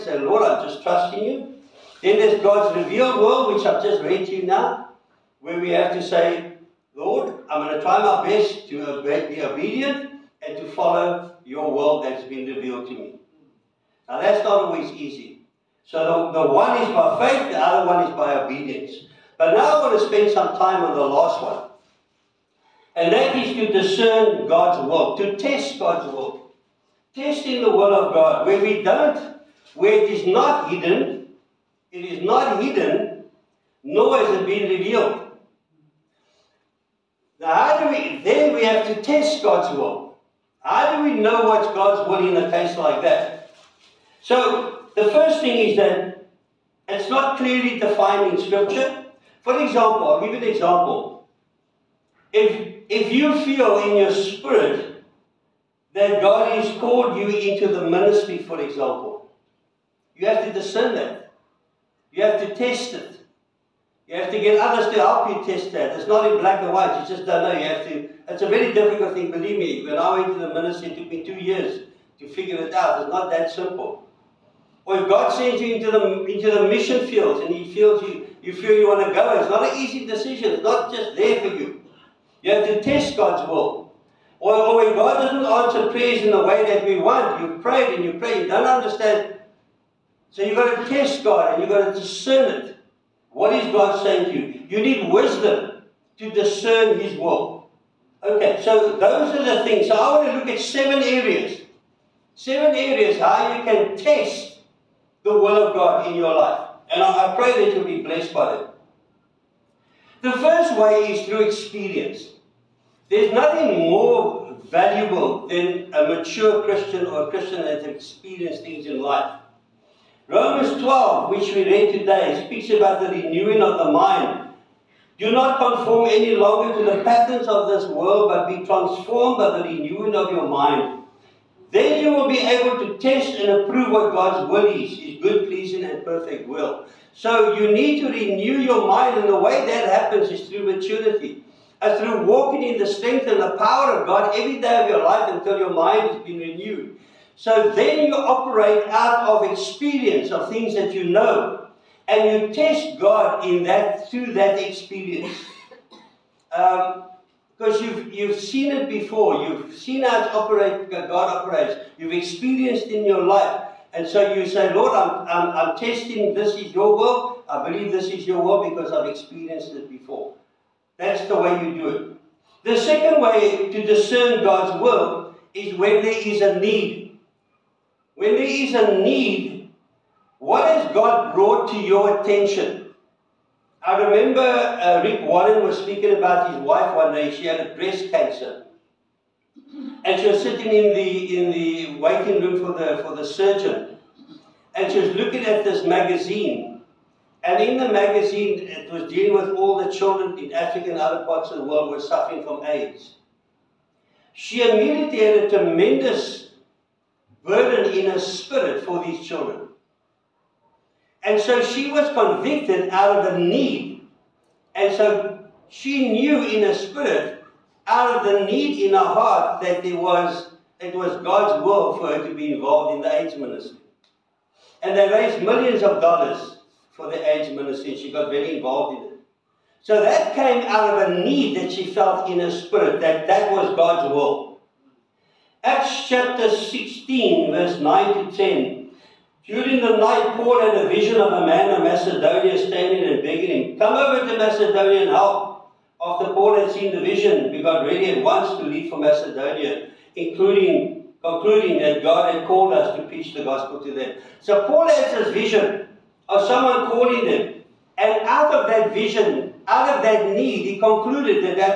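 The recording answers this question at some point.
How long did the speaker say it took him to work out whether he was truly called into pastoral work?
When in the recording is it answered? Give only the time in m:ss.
1:11.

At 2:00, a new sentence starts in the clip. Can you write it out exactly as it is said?
Romans 12, which we read today, speaks about the renewing of the mind.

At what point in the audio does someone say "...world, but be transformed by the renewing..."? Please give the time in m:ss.
2:07.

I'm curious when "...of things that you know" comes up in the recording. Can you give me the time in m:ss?
2:30.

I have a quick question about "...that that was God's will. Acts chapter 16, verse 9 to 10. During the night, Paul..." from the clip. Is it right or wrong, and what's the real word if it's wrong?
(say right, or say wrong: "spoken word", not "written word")
right.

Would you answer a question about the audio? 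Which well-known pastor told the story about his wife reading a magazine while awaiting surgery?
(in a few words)
Rick Warren.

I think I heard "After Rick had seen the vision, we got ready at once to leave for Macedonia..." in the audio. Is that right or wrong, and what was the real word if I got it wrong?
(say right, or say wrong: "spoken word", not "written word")
wrong: "Paul", not "Rick".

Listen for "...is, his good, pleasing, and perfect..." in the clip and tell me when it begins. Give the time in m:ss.
2:14.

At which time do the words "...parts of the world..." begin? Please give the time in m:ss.
3:21.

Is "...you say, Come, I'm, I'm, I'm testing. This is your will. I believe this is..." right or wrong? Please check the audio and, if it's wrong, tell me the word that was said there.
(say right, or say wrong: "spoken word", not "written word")
wrong: "Lord", not "Come".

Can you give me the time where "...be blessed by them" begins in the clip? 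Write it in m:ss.
1:47.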